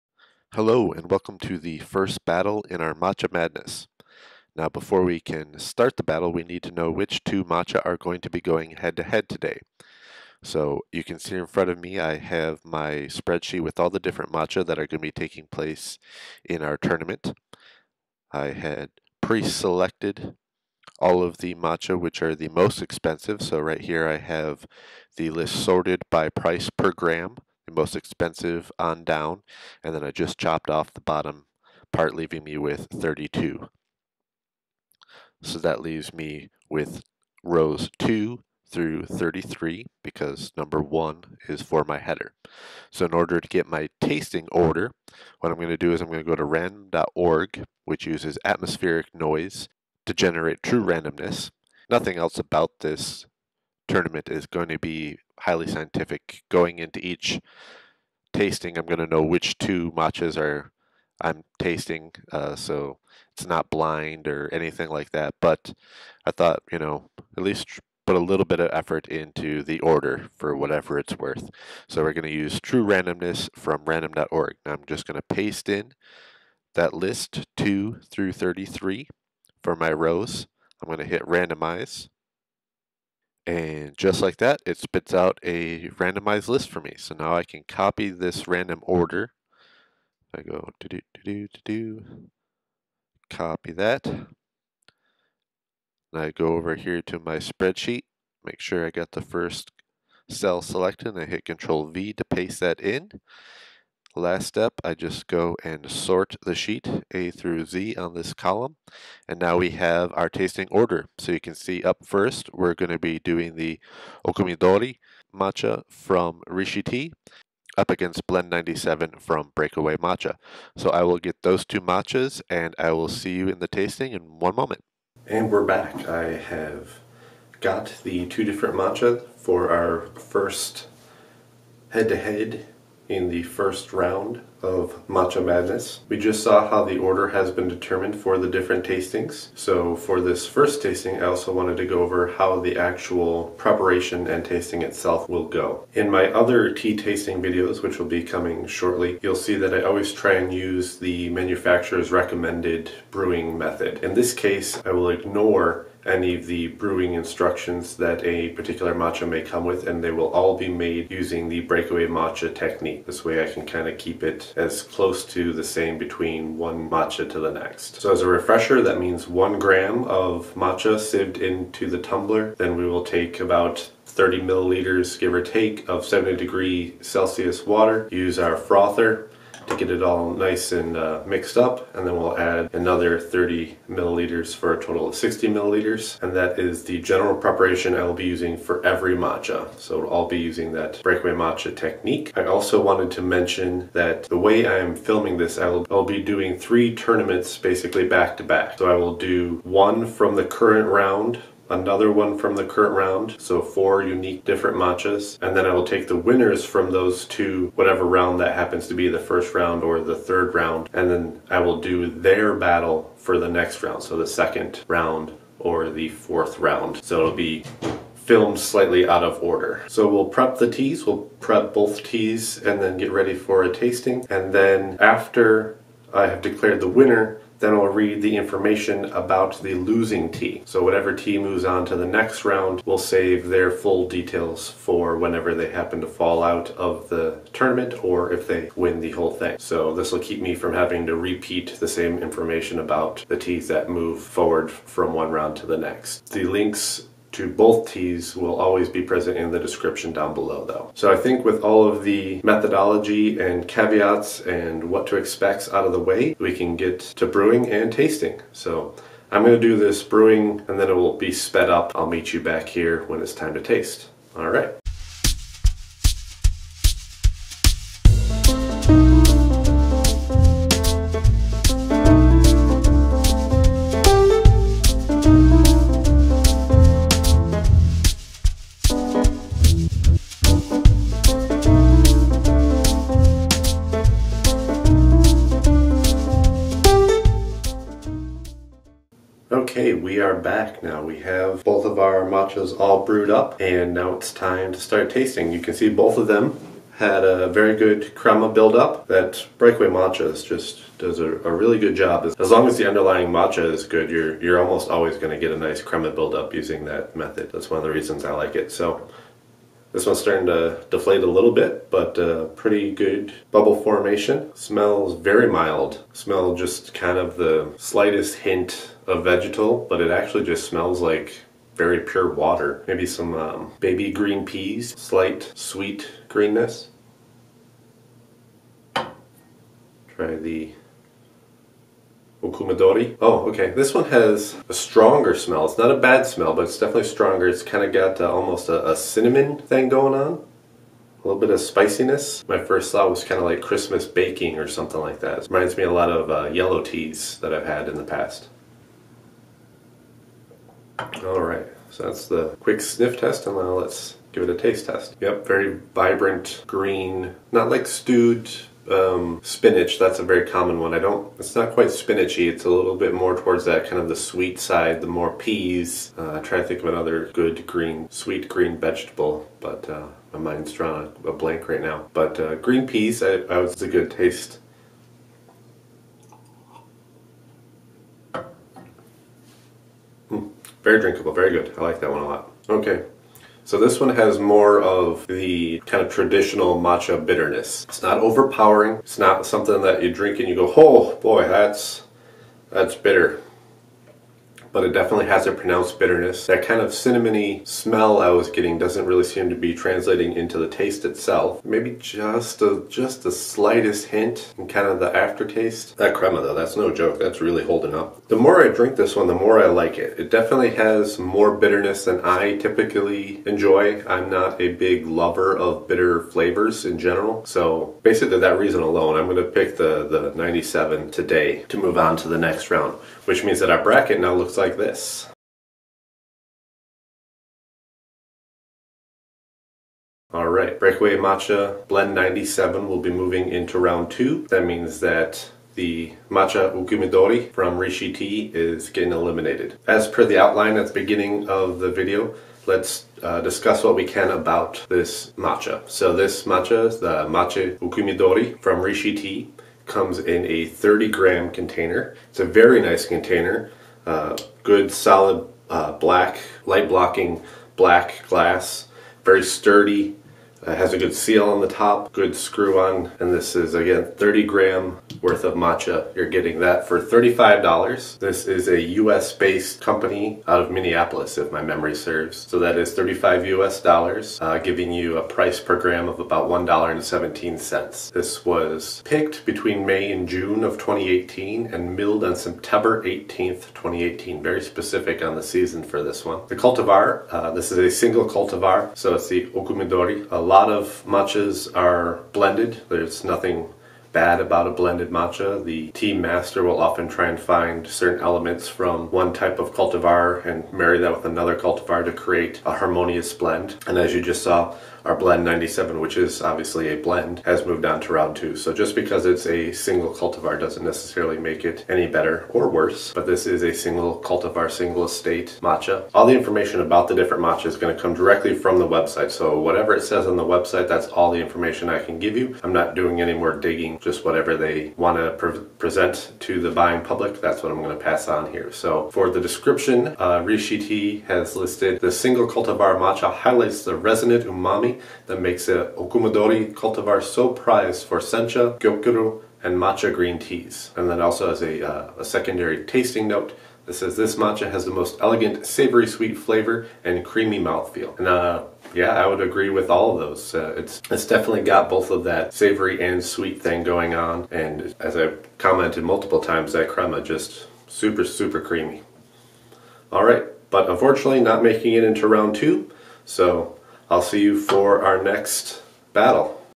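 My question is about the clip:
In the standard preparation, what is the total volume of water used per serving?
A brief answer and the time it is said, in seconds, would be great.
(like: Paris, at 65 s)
60 milliliters, at 185 s.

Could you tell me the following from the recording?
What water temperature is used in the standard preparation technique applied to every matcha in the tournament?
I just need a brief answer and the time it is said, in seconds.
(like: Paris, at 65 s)
70 degrees Celsius, at 176 s.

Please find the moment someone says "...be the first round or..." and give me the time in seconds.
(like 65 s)
208 s.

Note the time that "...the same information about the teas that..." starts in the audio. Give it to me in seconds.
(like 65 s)
241 s.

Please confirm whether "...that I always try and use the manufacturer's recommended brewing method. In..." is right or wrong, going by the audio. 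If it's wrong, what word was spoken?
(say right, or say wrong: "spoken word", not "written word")
right.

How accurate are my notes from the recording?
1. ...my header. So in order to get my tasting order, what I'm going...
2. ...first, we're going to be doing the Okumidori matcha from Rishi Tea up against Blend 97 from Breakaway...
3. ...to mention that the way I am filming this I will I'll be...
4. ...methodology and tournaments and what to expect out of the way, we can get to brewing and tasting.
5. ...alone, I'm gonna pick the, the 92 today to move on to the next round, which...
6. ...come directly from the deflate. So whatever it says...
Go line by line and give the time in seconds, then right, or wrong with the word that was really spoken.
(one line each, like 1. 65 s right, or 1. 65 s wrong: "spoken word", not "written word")
1. 41 s right
2. 112 s right
3. 193 s right
4. 252 s wrong: "caveats", not "tournaments"
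5. 418 s wrong: "97", not "92"
6. 518 s wrong: "website", not "deflate".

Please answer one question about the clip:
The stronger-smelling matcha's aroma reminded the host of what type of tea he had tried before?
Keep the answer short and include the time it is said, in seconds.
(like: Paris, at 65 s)
yellow teas, at 346 s.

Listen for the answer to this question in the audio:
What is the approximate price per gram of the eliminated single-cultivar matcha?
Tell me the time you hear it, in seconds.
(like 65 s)
476 s.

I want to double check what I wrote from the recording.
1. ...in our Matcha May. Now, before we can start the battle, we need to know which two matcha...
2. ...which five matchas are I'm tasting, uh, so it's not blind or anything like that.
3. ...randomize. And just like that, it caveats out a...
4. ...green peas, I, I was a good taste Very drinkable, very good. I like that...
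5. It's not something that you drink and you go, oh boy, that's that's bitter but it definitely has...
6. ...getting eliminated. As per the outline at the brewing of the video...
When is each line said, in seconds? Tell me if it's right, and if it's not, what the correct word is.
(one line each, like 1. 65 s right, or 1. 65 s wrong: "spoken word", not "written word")
1. 2 s wrong: "Madness", not "May"
2. 59 s wrong: "two", not "five"
3. 81 s wrong: "spits", not "caveats"
4. 372 s right
5. 388 s right
6. 438 s wrong: "beginning", not "brewing".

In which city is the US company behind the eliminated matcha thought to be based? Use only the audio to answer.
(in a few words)
Minneapolis.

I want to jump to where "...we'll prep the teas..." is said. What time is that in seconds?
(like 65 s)
220 s.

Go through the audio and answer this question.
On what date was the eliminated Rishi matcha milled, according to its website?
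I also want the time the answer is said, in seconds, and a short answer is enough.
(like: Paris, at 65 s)
September 18, 2018, at 482 s.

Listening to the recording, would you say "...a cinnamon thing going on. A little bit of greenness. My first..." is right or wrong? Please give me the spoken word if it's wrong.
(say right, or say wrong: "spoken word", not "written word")
wrong: "spiciness", not "greenness".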